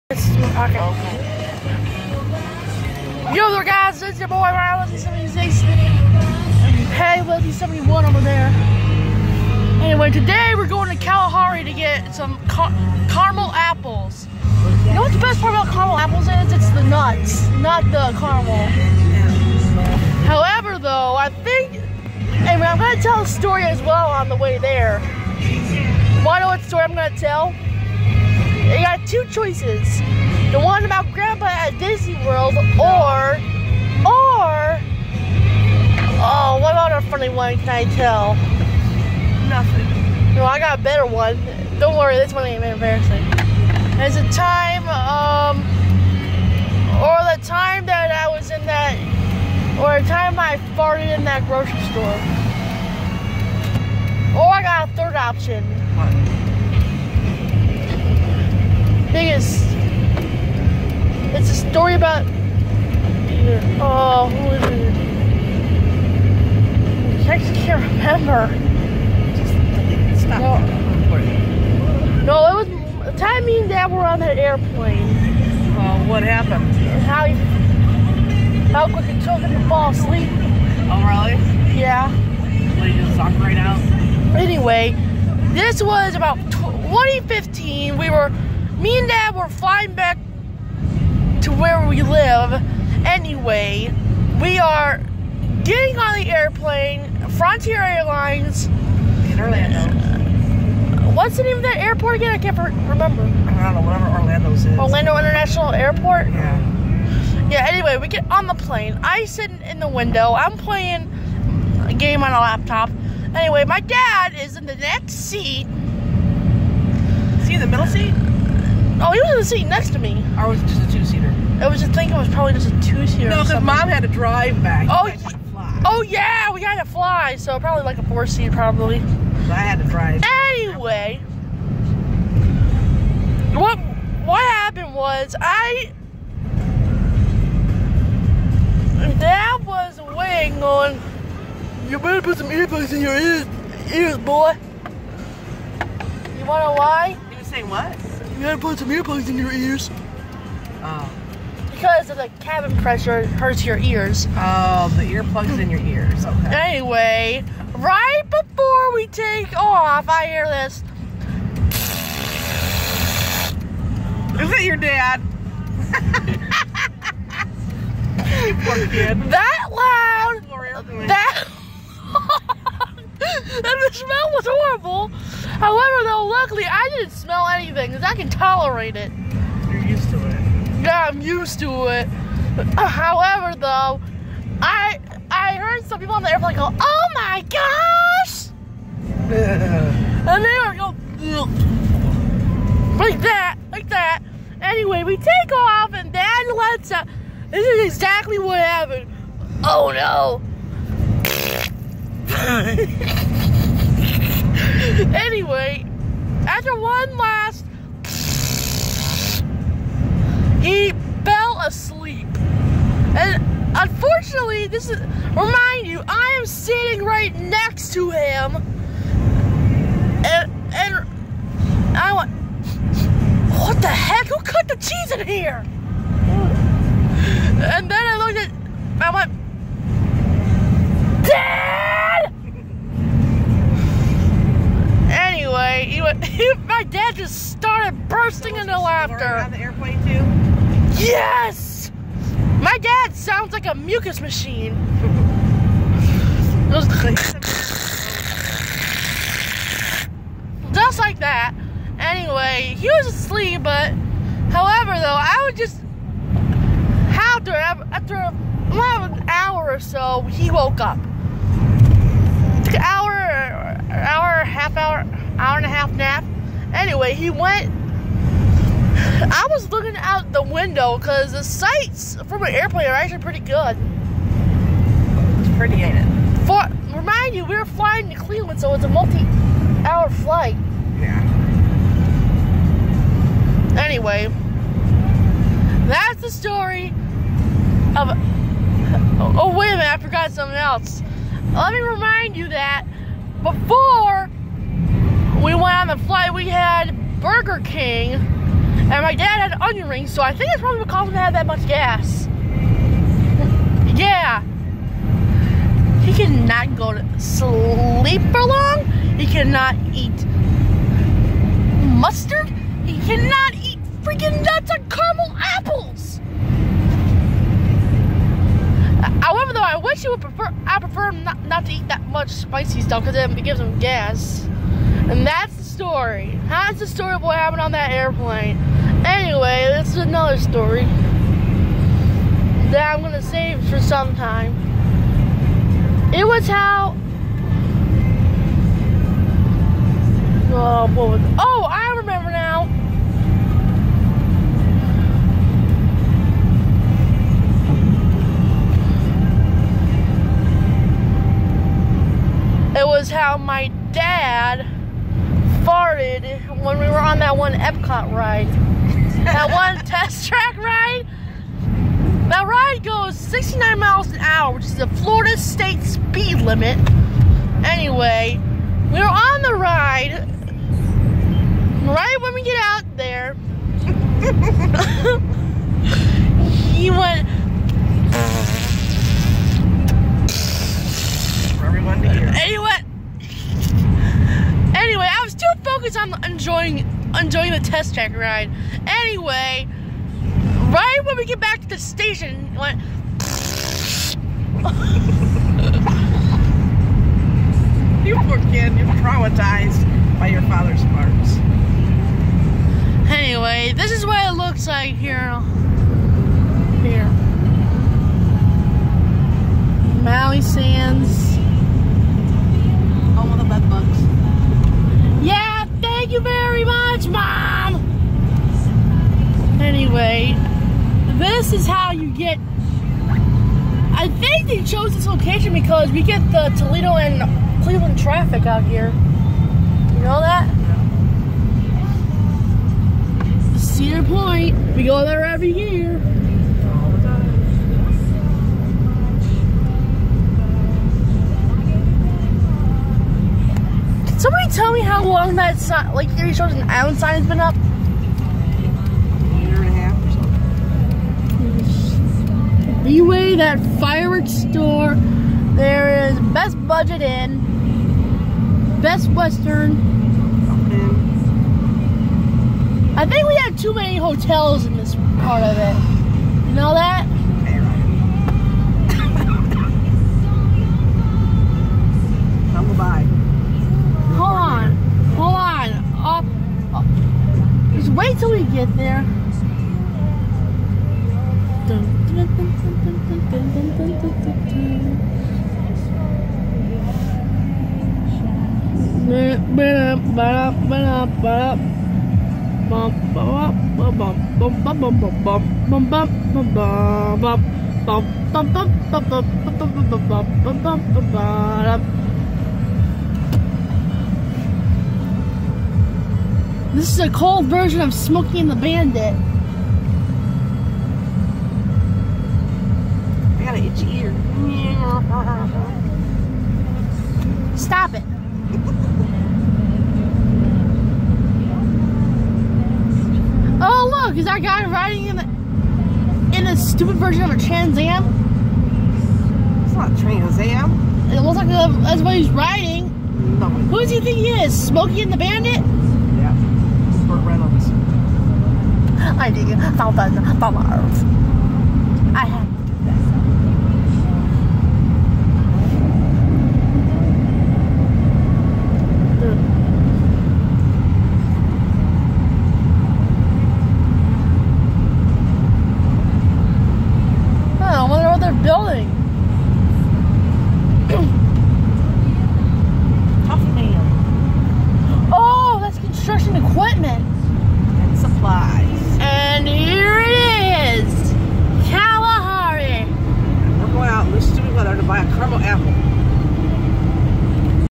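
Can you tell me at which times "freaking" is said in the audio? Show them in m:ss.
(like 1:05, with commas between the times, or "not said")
5:14.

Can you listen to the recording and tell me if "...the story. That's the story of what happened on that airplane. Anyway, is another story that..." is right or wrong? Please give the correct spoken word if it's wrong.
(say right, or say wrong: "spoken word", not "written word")
right.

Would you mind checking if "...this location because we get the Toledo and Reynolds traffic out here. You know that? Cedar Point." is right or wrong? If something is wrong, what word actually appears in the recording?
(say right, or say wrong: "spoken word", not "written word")
wrong: "Cleveland", not "Reynolds".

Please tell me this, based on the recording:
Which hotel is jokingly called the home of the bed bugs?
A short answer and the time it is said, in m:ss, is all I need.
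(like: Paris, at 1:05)
Maui Sands, at 6:50.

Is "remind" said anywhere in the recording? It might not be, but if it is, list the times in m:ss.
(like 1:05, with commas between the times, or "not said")
3:35, 4:36, 4:51.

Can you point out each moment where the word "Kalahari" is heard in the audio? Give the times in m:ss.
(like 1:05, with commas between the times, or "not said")
0:11.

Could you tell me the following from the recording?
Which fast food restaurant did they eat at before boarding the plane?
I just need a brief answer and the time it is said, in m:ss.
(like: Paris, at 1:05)
Burger King, at 4:57.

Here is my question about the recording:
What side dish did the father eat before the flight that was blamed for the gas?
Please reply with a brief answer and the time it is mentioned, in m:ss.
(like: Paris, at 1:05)
onion rings, at 4:59.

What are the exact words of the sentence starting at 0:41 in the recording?
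Don't worry, this one ain't embarrassing.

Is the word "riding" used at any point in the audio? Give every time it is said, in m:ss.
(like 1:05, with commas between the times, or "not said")
8:44, 8:52.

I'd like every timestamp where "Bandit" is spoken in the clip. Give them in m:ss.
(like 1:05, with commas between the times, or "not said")
8:28, 8:55.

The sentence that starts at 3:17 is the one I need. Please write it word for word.
Uh, this is exactly what happened.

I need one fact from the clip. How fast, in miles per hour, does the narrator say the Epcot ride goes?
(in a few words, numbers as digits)
69.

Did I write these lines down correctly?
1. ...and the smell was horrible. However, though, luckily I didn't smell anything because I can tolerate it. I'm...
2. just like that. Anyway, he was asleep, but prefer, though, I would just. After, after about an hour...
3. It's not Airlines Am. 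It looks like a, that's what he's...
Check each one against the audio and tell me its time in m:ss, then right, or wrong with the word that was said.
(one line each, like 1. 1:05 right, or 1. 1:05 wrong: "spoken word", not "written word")
1. 2:52 right
2. 4:10 wrong: "however", not "prefer"
3. 8:49 wrong: "Trans", not "Airlines".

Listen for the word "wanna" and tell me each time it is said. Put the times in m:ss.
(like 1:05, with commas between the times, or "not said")
2:26.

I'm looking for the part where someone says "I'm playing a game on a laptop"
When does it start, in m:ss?
1:50.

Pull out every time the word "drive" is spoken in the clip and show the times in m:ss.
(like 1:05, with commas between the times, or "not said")
2:04, 2:09.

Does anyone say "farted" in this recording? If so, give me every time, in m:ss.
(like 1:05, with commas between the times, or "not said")
0:50, 5:55.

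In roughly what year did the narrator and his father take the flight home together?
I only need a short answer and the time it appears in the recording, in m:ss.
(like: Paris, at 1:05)
2015, at 1:26.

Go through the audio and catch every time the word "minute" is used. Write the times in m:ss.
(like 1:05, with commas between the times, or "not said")
4:49.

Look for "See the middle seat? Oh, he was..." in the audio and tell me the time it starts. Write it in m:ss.
1:57.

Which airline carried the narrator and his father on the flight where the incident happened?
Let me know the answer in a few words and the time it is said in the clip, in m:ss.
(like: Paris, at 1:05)
Frontier Airlines, at 1:37.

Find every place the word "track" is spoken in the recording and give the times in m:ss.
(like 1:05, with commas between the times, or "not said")
6:00, 6:27.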